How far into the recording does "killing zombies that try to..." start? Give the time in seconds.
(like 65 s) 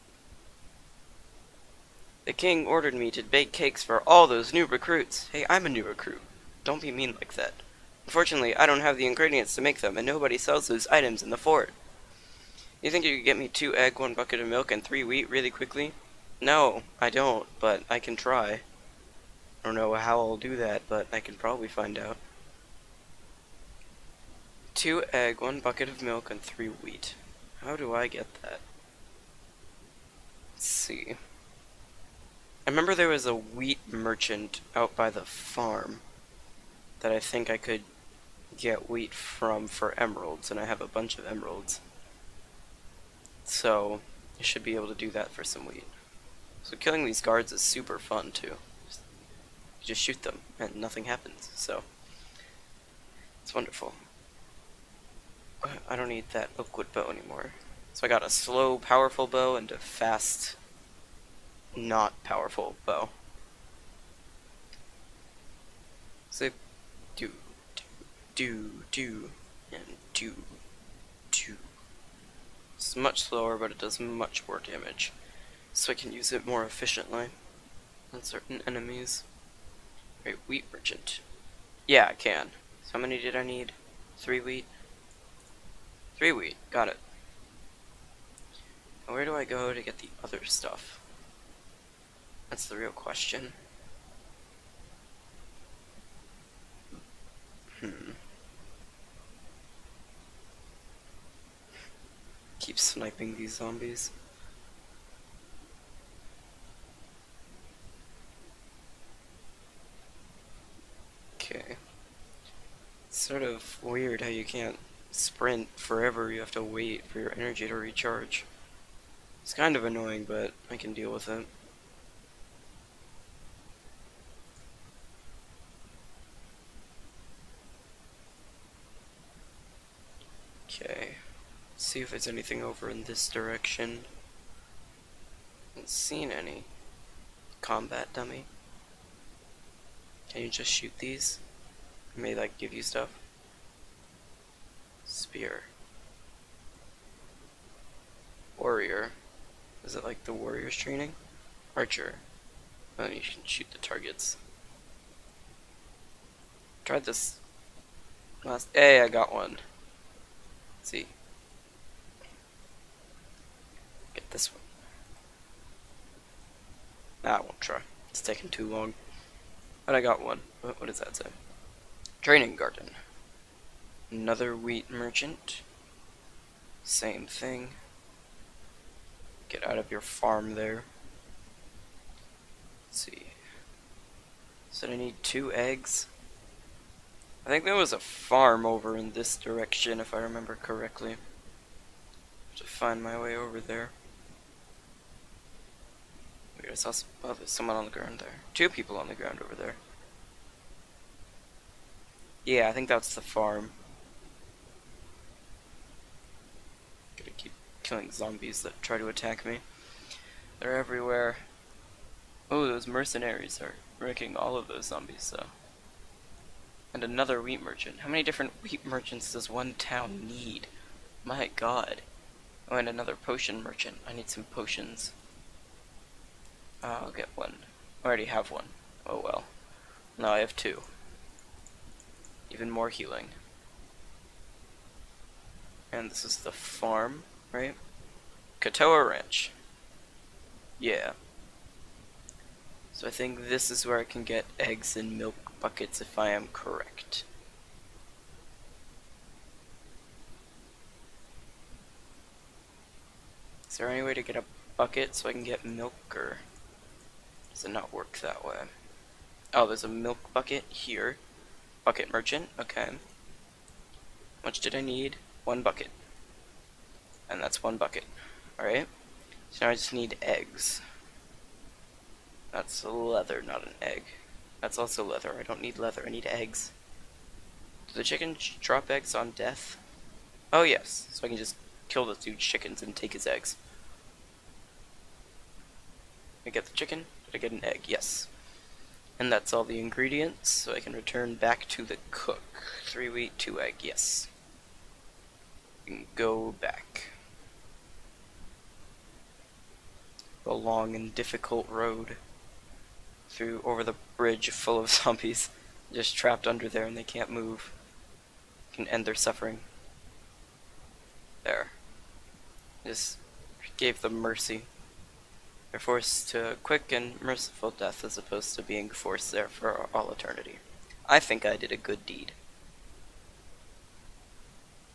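207 s.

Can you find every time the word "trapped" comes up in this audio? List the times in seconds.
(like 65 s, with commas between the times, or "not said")
306 s.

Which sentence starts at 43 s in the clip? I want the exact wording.
So, I should be able to do that for some wheat.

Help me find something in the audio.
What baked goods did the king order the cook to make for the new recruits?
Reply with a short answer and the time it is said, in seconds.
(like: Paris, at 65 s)
Cakes, at 3 s.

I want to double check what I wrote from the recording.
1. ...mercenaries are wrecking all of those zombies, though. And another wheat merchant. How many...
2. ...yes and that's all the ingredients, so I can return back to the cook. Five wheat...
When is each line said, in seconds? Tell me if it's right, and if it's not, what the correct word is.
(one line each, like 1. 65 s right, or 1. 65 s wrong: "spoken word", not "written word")
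1. 212 s right
2. 287 s wrong: "Three", not "Five".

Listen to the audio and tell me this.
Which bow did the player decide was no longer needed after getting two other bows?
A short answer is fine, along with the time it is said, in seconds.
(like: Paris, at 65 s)
Oakwood bow, at 56 s.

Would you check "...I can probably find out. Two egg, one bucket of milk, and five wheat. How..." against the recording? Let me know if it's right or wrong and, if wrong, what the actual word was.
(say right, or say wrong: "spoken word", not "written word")
wrong: "three", not "five".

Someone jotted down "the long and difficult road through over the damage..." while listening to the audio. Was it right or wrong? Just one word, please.
wrong.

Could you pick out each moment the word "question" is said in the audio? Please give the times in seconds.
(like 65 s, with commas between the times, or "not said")
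92 s.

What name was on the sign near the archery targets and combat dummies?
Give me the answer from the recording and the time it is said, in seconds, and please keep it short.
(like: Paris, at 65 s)
Training garden, at 172 s.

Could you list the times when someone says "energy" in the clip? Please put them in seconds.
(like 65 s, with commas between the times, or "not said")
117 s.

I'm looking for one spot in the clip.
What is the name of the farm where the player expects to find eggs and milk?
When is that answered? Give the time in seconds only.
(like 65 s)
238 s.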